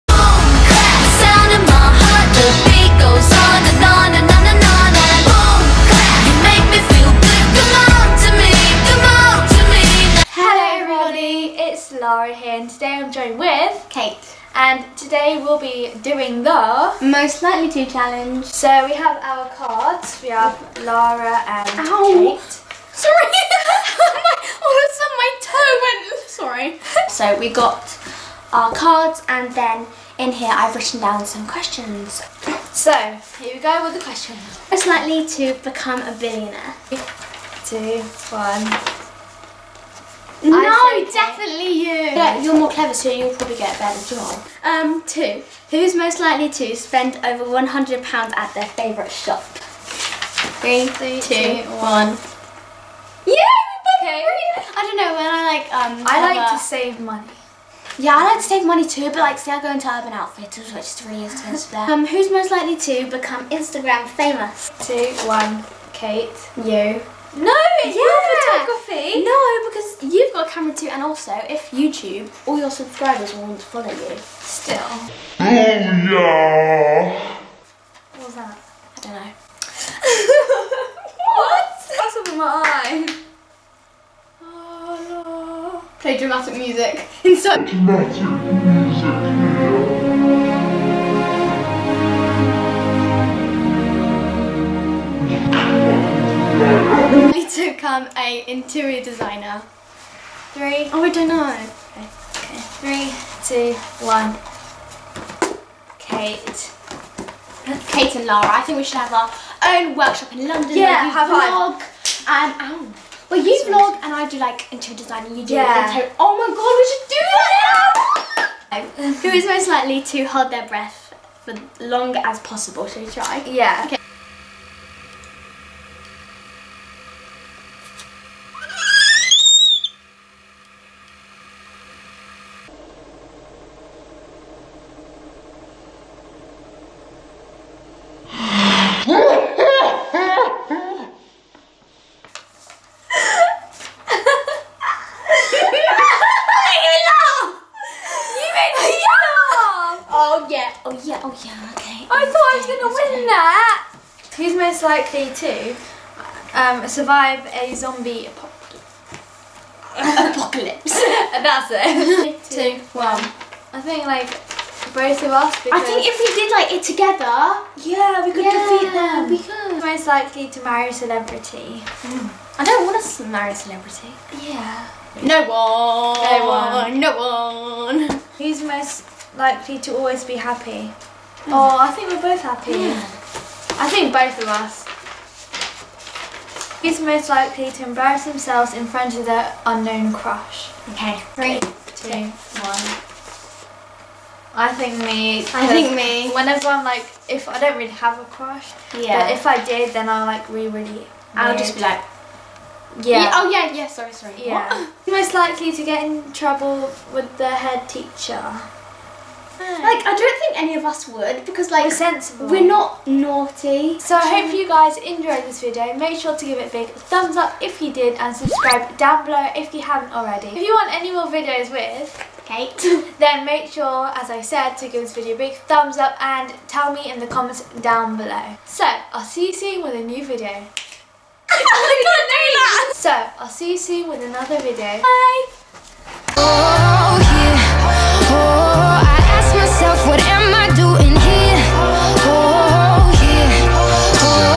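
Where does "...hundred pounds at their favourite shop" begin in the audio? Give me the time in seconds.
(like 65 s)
47 s.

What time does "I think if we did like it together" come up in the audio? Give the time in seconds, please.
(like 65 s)
165 s.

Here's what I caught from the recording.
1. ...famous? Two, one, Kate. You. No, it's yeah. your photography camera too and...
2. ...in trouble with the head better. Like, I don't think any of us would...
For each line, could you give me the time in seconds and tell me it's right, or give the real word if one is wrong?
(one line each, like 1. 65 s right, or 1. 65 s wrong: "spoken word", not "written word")
1. 64 s right
2. 206 s wrong: "teacher", not "better".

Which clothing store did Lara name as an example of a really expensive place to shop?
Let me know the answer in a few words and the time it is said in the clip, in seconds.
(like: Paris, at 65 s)
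Urban Outfitters, at 59 s.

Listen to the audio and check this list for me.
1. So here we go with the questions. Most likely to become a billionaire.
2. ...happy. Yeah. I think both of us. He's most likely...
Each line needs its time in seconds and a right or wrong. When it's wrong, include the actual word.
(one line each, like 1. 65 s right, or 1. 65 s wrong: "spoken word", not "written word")
1. 32 s right
2. 182 s right.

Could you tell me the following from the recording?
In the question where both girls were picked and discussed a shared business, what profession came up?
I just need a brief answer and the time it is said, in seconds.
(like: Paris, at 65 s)
Interior designer, at 98 s.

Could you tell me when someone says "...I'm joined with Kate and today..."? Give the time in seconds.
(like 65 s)
12 s.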